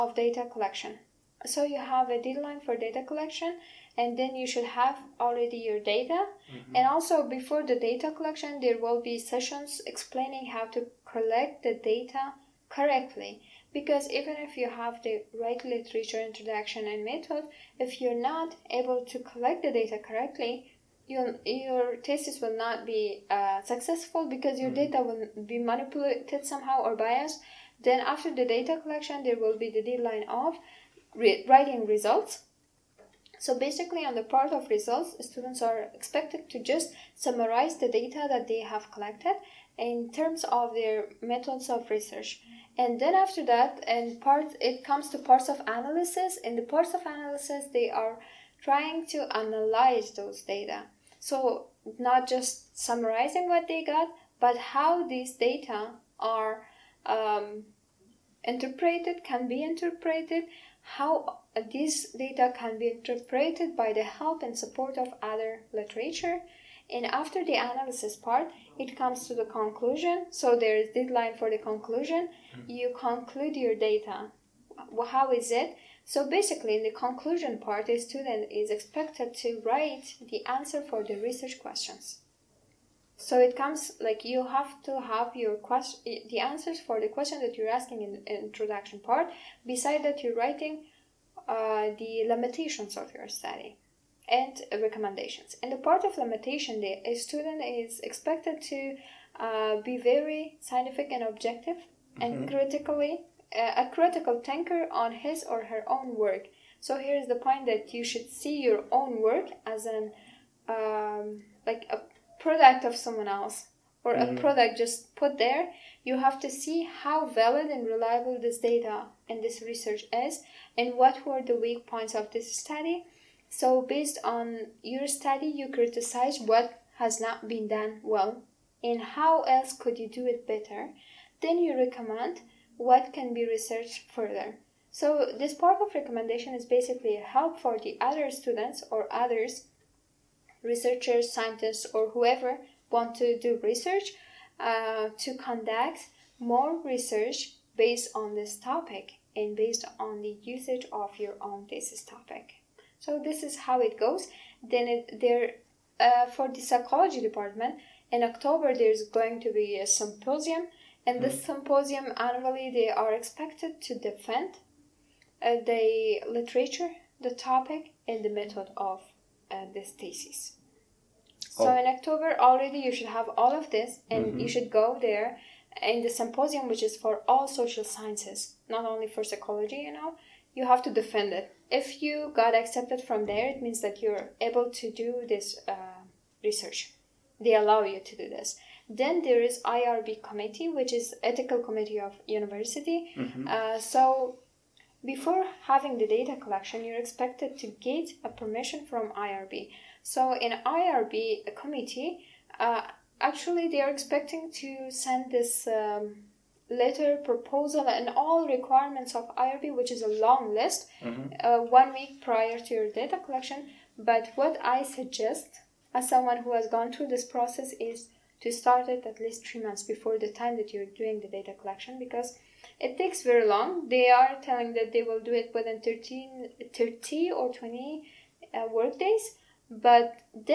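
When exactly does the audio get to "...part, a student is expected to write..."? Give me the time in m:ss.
1:17.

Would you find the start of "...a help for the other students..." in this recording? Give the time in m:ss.
2:17.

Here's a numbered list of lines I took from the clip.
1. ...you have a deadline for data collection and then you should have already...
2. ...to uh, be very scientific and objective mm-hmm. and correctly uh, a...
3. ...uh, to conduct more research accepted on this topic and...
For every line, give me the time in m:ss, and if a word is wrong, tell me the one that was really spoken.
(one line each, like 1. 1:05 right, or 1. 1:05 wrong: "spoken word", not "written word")
1. 0:01 right
2. 1:38 wrong: "critically", not "correctly"
3. 2:24 wrong: "based", not "accepted".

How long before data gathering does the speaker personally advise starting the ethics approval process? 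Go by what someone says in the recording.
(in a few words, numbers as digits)
three months.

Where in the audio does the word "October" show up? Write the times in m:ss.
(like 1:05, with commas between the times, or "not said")
2:38, 2:51.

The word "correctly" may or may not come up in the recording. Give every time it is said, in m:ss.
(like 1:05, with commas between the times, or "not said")
0:12, 0:20.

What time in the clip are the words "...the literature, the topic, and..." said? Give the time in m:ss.
2:45.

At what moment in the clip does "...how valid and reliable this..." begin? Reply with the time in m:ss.
1:57.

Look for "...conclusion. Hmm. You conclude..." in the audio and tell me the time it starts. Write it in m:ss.
1:11.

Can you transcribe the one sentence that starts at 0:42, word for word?
And then after that, and part it comes to parts of analysis.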